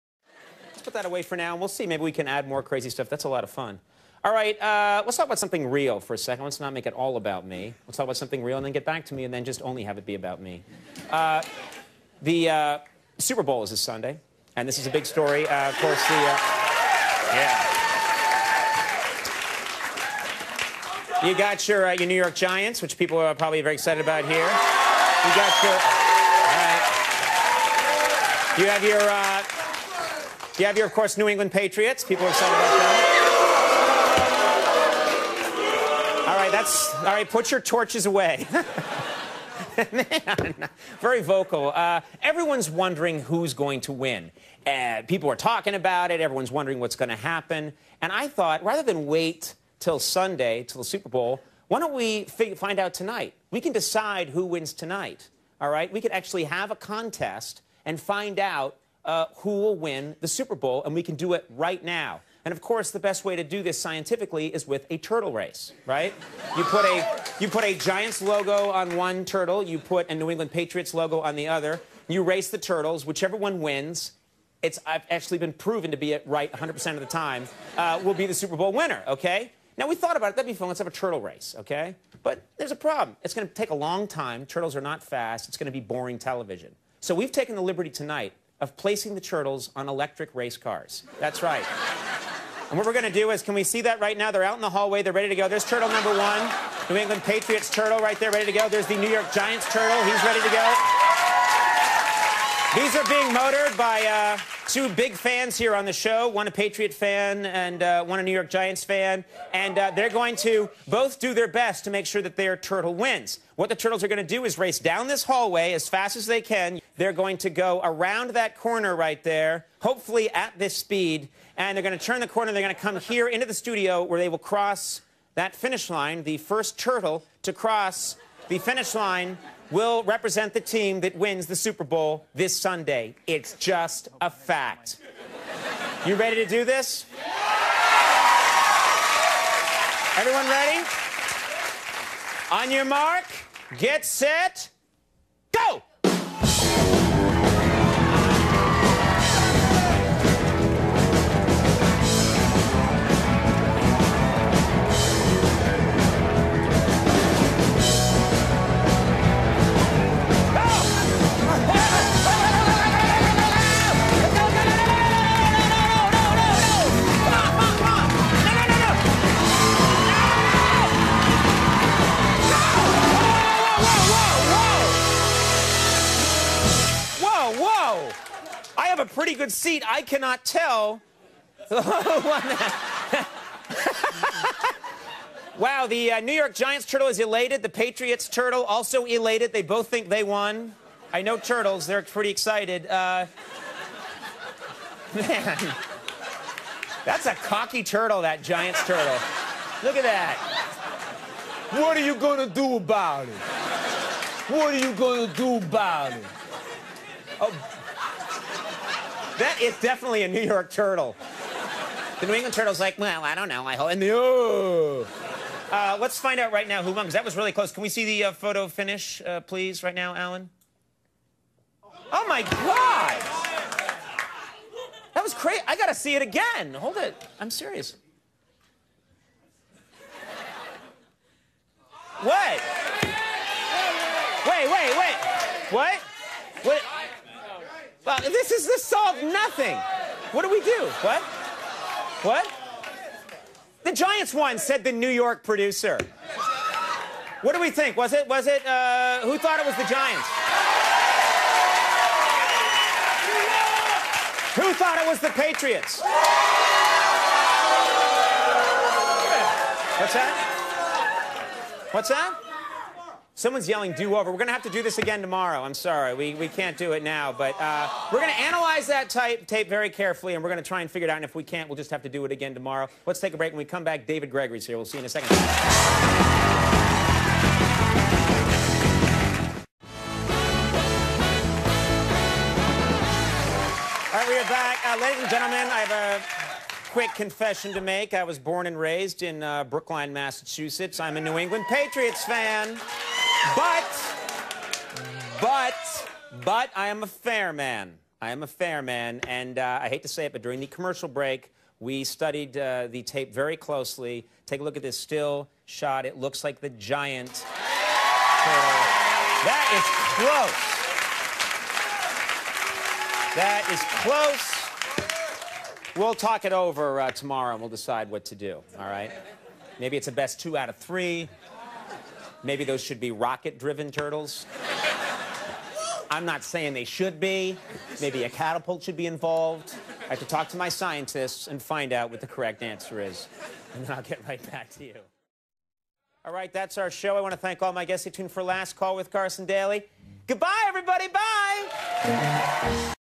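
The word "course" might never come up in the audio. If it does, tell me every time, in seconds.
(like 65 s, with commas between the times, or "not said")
15 s, 30 s, 62 s.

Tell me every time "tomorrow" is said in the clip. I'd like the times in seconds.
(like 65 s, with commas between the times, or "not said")
265 s, 272 s, 317 s.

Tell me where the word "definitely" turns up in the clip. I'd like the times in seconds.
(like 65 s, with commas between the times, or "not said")
209 s.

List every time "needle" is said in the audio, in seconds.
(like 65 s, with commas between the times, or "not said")
not said.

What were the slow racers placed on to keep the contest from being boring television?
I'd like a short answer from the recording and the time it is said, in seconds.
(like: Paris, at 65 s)
Electric race cars, at 89 s.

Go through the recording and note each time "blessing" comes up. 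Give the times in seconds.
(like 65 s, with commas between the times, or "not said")
not said.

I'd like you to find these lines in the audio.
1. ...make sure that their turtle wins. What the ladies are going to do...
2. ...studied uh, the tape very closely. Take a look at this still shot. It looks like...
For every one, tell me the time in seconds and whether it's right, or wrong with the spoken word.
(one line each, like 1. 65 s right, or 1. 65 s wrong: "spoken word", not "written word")
1. 111 s wrong: "turtles", not "ladies"
2. 302 s right.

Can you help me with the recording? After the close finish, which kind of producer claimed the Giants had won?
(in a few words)
The New York producer.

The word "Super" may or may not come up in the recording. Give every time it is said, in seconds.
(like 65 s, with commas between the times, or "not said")
13 s, 50 s, 60 s, 78 s, 131 s.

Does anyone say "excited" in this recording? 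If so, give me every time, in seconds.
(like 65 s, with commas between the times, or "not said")
23 s, 32 s, 192 s.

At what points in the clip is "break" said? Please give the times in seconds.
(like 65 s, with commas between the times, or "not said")
273 s, 301 s.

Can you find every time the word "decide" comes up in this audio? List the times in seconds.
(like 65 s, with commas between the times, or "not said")
53 s, 317 s.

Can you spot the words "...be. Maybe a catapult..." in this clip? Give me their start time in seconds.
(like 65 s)
327 s.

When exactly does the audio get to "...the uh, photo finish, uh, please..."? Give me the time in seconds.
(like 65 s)
218 s.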